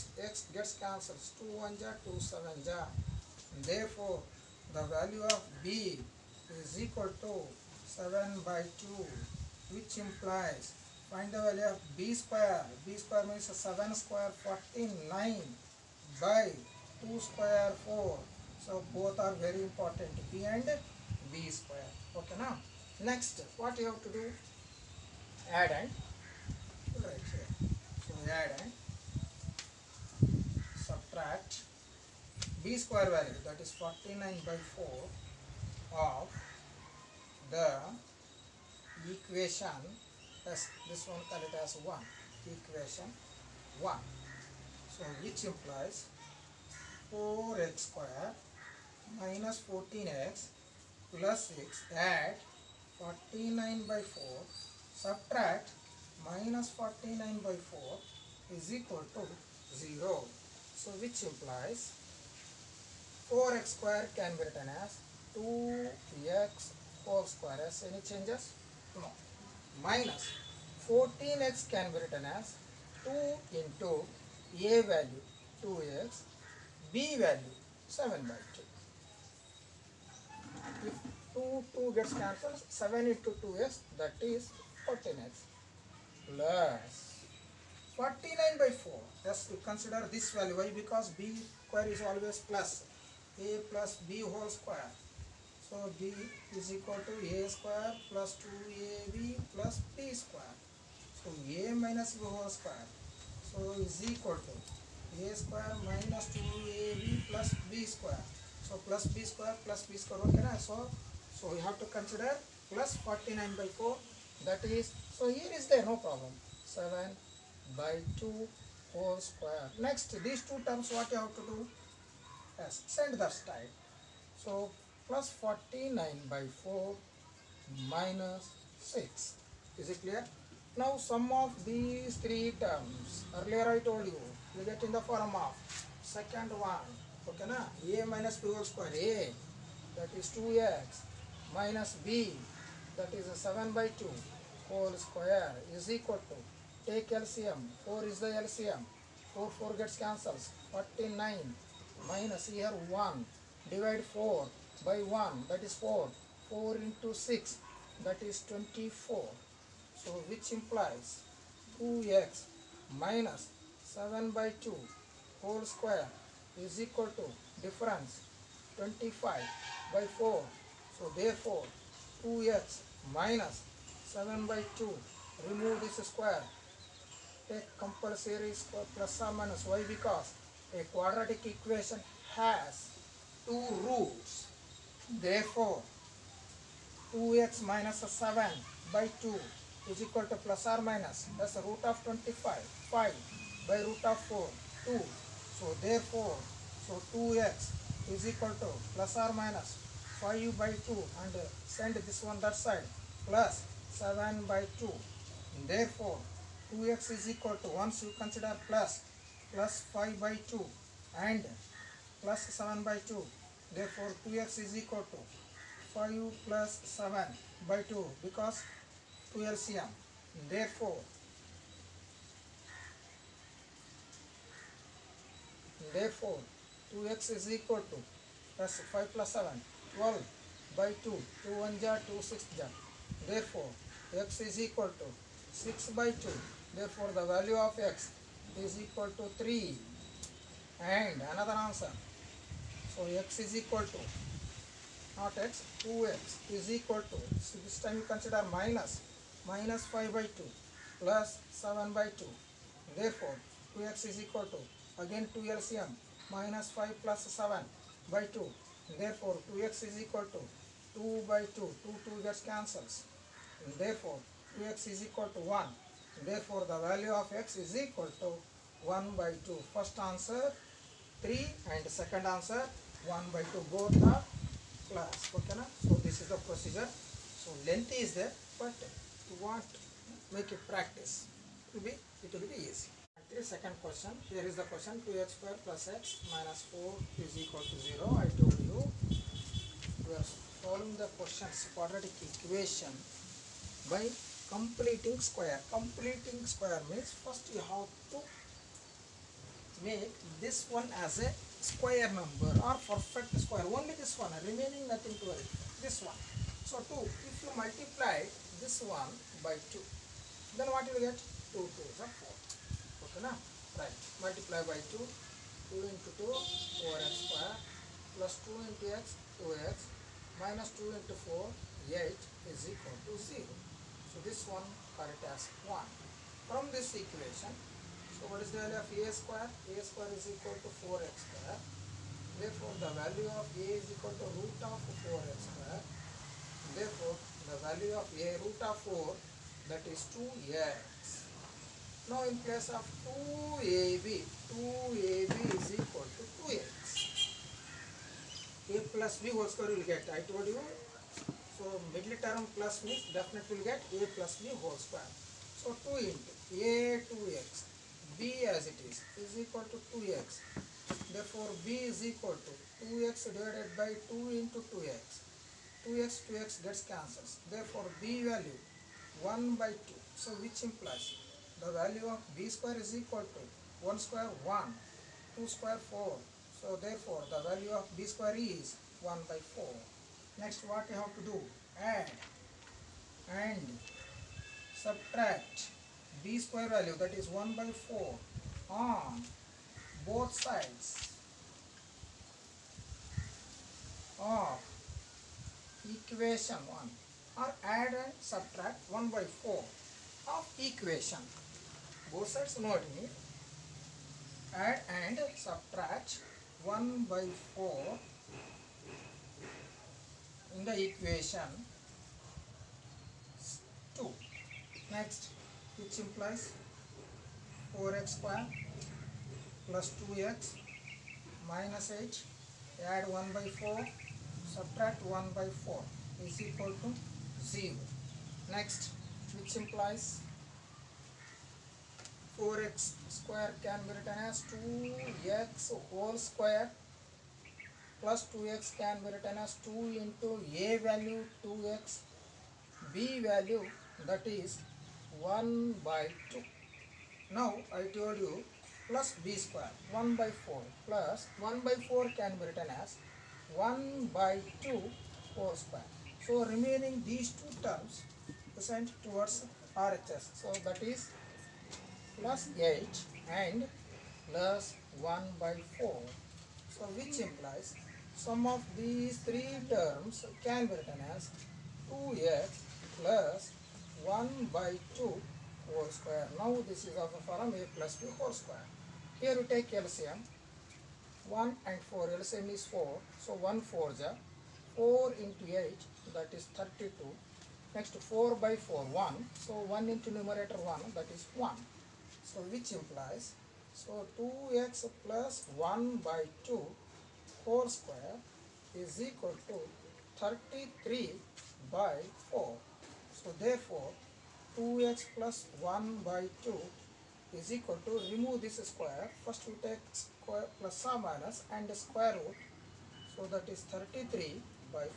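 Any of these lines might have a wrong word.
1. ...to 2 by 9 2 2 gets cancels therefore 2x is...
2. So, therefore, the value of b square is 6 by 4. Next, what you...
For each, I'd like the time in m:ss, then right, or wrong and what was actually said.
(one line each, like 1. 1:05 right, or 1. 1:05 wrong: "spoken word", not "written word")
1. 4:20 wrong: "2", not "9"
2. 6:16 wrong: "1", not "6".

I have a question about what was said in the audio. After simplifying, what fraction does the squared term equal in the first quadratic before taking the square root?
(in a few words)
25/4.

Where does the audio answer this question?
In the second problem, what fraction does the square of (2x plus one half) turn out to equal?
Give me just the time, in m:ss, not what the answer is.
8:20.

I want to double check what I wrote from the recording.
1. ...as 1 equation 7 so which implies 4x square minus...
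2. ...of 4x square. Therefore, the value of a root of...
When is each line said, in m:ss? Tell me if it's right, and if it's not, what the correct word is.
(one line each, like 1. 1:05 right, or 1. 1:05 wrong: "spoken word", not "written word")
1. 0:41 wrong: "1", not "7"
2. 5:34 right.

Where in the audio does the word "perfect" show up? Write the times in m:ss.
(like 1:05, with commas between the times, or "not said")
5:02.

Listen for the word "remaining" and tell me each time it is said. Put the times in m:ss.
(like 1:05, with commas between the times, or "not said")
5:04, 7:36.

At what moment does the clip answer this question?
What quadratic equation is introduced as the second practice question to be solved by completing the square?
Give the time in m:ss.
4:45.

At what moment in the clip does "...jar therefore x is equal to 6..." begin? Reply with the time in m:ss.
3:52.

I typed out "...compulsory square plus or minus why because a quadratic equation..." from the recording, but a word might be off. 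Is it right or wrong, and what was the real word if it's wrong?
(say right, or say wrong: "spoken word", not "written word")
right.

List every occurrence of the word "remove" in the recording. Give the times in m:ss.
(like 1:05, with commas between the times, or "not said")
2:55, 8:28.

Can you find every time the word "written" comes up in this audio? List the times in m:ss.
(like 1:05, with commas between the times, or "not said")
1:04, 1:11, 7:13, 7:19, 7:32, 7:50.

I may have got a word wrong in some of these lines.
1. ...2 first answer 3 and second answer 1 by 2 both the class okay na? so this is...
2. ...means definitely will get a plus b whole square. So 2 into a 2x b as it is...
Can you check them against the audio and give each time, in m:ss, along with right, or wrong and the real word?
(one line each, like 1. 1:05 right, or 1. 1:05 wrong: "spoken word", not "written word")
1. 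4:29 right
2. 5:52 right.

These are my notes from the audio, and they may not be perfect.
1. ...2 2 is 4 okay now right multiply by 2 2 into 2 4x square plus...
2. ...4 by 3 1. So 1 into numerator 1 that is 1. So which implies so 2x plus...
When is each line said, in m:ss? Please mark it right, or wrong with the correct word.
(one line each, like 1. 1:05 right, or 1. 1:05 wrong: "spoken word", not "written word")
1. 5:11 right
2. 8:08 wrong: "4", not "3".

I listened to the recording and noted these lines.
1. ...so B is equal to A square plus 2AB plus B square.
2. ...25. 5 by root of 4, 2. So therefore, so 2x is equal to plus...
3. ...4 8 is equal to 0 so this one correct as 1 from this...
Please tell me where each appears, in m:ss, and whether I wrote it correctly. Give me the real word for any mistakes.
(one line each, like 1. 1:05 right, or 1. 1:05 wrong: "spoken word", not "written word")
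1. 1:35 right
2. 3:12 right
3. 5:21 right.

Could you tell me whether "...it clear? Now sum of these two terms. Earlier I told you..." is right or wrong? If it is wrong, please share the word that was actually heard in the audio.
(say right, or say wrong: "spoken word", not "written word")
wrong: "three", not "two".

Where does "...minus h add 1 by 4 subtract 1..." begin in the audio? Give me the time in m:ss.
7:01.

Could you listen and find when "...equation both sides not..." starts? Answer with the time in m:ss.
6:40.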